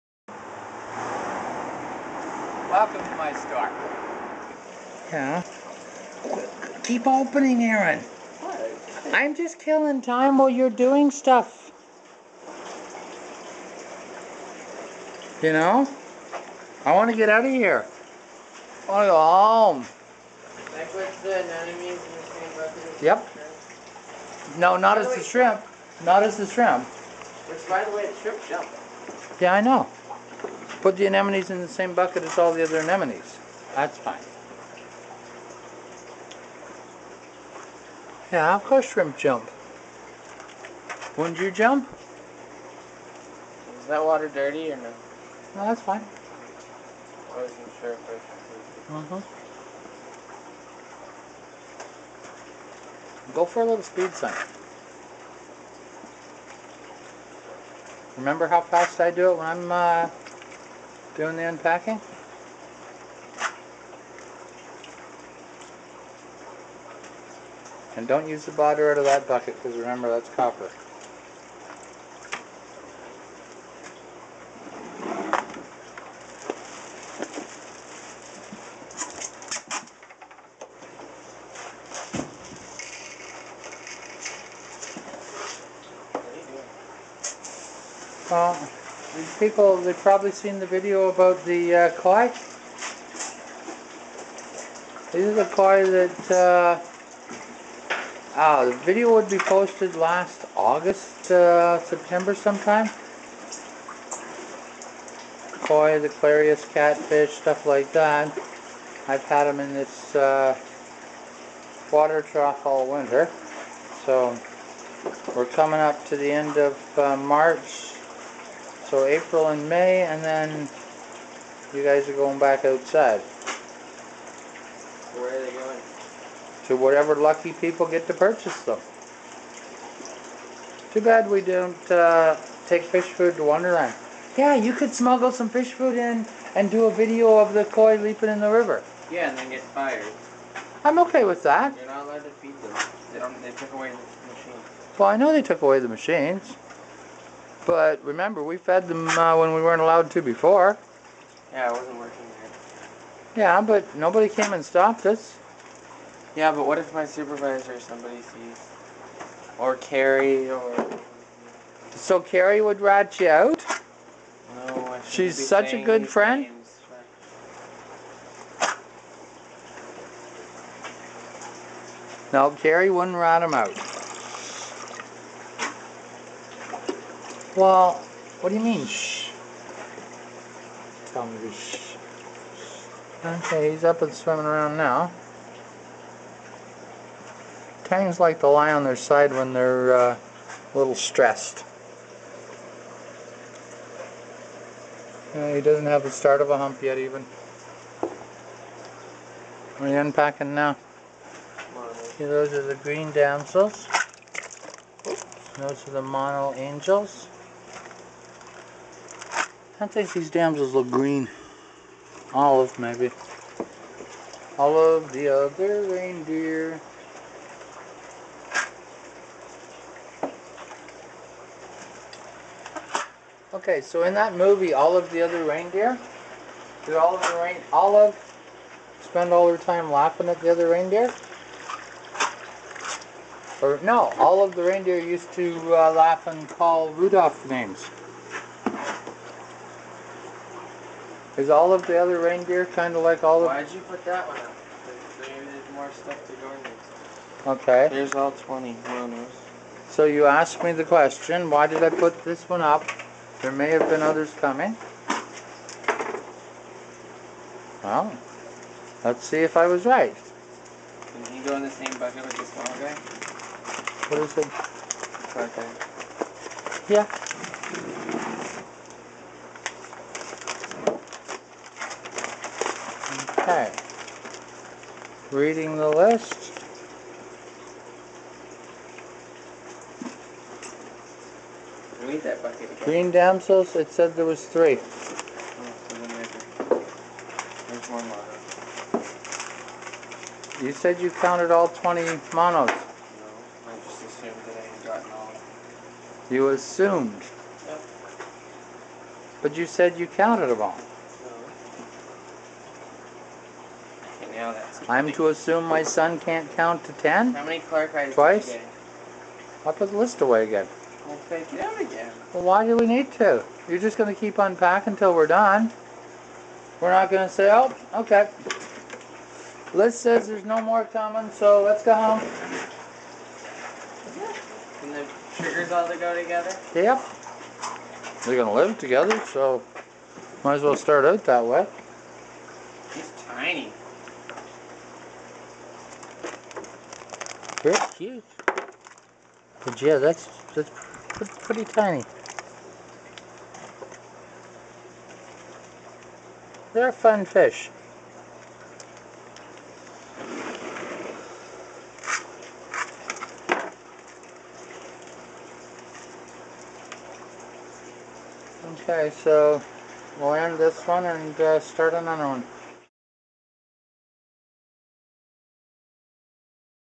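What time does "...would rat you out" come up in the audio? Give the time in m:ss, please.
2:42.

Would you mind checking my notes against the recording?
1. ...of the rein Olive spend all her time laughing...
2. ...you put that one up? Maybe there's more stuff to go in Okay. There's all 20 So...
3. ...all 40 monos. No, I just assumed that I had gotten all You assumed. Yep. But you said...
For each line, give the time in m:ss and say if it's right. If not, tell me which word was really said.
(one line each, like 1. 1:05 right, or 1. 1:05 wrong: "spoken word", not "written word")
1. 3:46 right
2. 4:03 right
3. 4:51 wrong: "20", not "40".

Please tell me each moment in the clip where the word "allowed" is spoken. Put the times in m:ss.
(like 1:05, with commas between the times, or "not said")
2:22, 2:29.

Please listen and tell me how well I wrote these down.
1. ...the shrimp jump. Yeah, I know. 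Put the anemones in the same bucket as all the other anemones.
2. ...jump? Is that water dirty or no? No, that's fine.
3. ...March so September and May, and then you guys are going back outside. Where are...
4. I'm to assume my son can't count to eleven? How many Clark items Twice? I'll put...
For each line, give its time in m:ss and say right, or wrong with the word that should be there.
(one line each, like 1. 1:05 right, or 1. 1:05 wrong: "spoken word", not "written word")
1. 0:28 right
2. 0:41 right
3. 1:57 wrong: "April", not "September"
4. 5:04 wrong: "ten", not "eleven".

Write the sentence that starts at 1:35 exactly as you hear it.
These are the koi that, uh, ah, the video would be posted last August, uh, September sometime.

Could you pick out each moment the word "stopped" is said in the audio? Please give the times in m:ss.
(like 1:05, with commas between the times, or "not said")
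2:34.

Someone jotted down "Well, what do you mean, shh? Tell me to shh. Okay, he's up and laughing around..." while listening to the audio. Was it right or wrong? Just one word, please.
wrong.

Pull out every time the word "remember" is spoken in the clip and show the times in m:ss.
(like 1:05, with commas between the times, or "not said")
0:58, 1:09, 2:28.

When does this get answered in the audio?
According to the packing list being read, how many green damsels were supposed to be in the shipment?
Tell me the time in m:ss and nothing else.
4:44.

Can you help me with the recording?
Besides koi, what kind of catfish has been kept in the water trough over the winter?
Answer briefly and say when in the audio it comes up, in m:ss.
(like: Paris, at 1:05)
Clarias catfish, at 1:46.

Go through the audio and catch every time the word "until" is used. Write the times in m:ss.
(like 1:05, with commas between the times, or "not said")
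5:14.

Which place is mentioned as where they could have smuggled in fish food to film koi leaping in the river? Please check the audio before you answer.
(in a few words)
Wonderland.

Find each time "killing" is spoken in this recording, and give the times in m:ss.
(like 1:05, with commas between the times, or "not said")
0:09.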